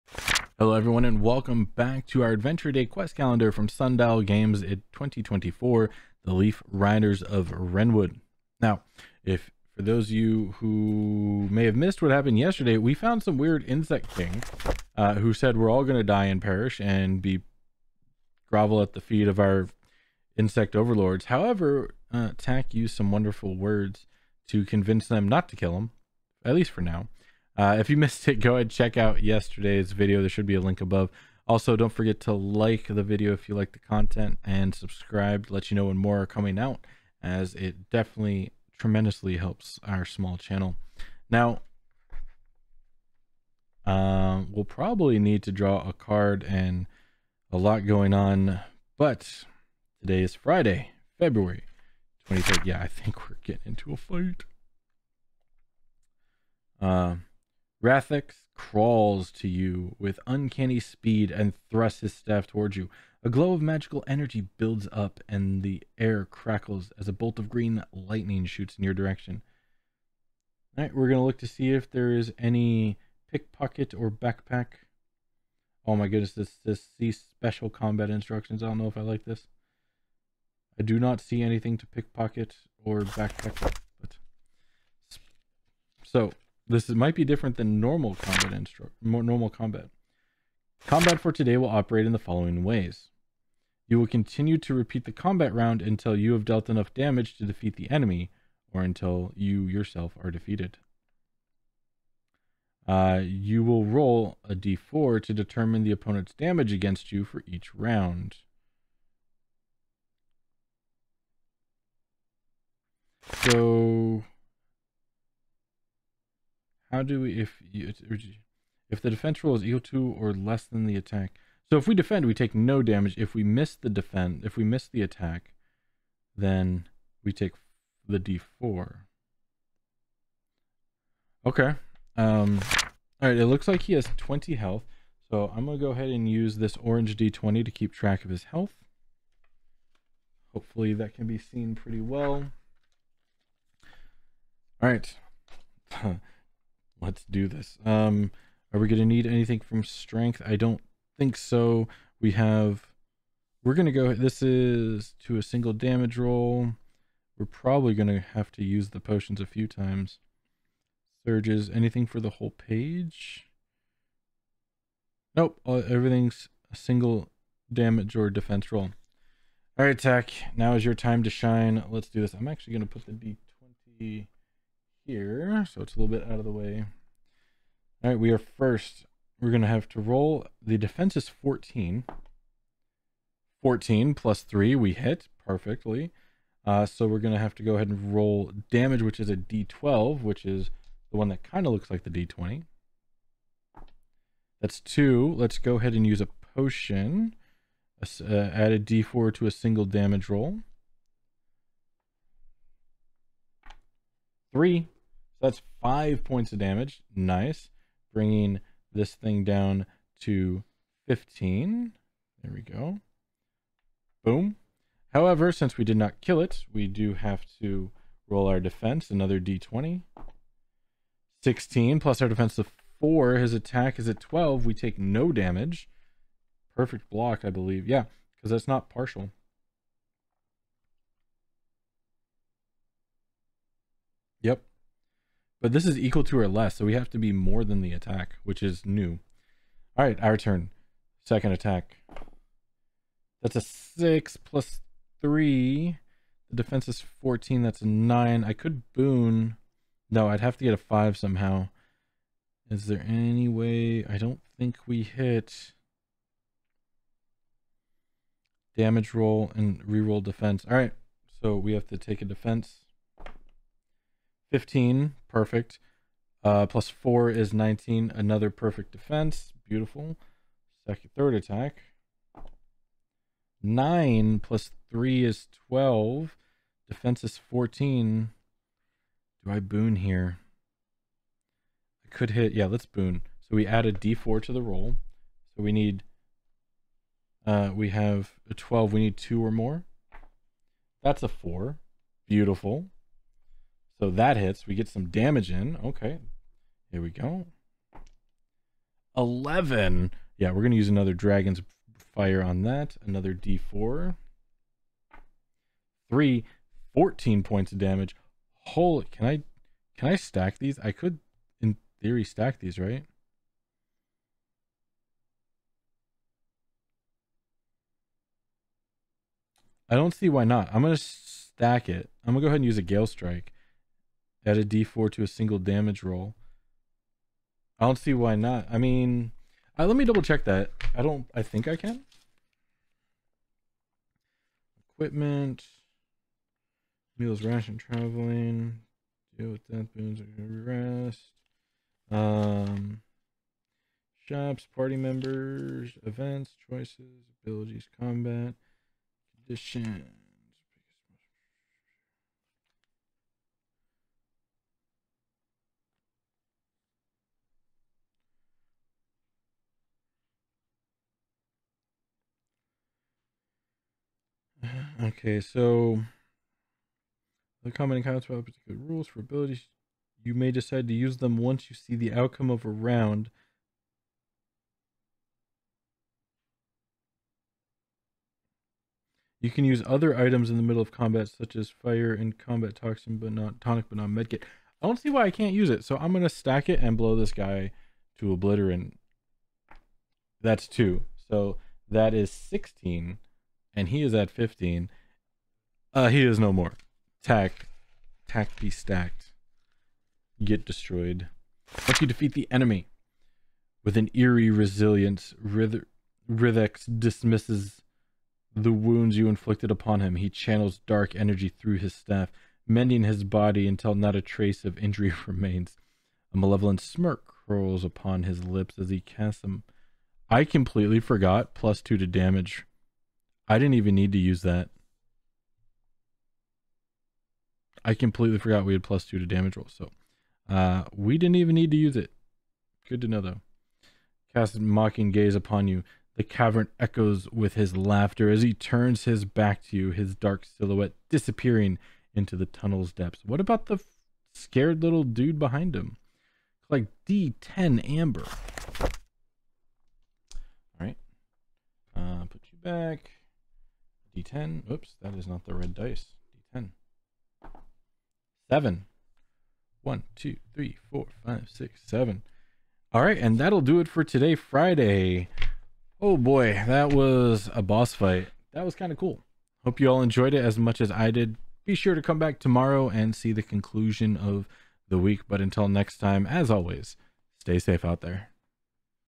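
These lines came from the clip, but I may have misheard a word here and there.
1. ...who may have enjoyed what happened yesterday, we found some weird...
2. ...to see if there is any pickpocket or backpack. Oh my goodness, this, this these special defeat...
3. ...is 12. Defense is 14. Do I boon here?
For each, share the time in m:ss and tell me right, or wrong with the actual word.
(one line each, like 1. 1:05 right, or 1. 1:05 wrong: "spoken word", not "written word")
1. 0:10 wrong: "missed", not "enjoyed"
2. 1:11 wrong: "combat", not "defeat"
3. 4:35 right.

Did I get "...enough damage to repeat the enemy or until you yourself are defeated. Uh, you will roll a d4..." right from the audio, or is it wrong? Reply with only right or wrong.
wrong.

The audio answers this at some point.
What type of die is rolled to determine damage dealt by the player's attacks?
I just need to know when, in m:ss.
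3:09.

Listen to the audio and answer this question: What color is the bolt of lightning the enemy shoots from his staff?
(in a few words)
Green.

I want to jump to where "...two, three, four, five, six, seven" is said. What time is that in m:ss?
7:40.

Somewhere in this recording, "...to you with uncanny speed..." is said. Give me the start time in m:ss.
0:59.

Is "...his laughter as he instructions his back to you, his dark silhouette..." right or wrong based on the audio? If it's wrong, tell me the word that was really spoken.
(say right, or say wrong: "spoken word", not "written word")
wrong: "turns", not "instructions".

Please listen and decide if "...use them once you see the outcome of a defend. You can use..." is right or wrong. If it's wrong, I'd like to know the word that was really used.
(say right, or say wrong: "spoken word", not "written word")
wrong: "round", not "defend".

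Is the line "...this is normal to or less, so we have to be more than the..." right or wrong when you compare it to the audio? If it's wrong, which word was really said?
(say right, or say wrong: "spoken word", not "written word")
wrong: "equal", not "normal".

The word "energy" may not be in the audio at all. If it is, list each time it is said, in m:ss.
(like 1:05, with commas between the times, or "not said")
1:04, 6:51.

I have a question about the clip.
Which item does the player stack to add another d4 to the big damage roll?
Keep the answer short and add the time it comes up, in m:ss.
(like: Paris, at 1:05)
Gale Strike, at 5:22.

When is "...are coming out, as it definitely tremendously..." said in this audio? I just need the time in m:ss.
0:36.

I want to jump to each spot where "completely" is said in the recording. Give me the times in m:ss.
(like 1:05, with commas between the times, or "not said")
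7:00, 7:07.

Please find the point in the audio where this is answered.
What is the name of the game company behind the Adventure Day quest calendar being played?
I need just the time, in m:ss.
0:03.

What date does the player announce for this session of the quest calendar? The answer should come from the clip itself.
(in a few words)
Friday, February 23rd.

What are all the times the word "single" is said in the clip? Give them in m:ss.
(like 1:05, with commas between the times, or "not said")
2:35, 2:46, 3:19, 5:25.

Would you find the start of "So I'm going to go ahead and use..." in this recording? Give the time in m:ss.
2:15.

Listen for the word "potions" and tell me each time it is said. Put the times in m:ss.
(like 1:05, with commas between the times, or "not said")
2:38, 3:16.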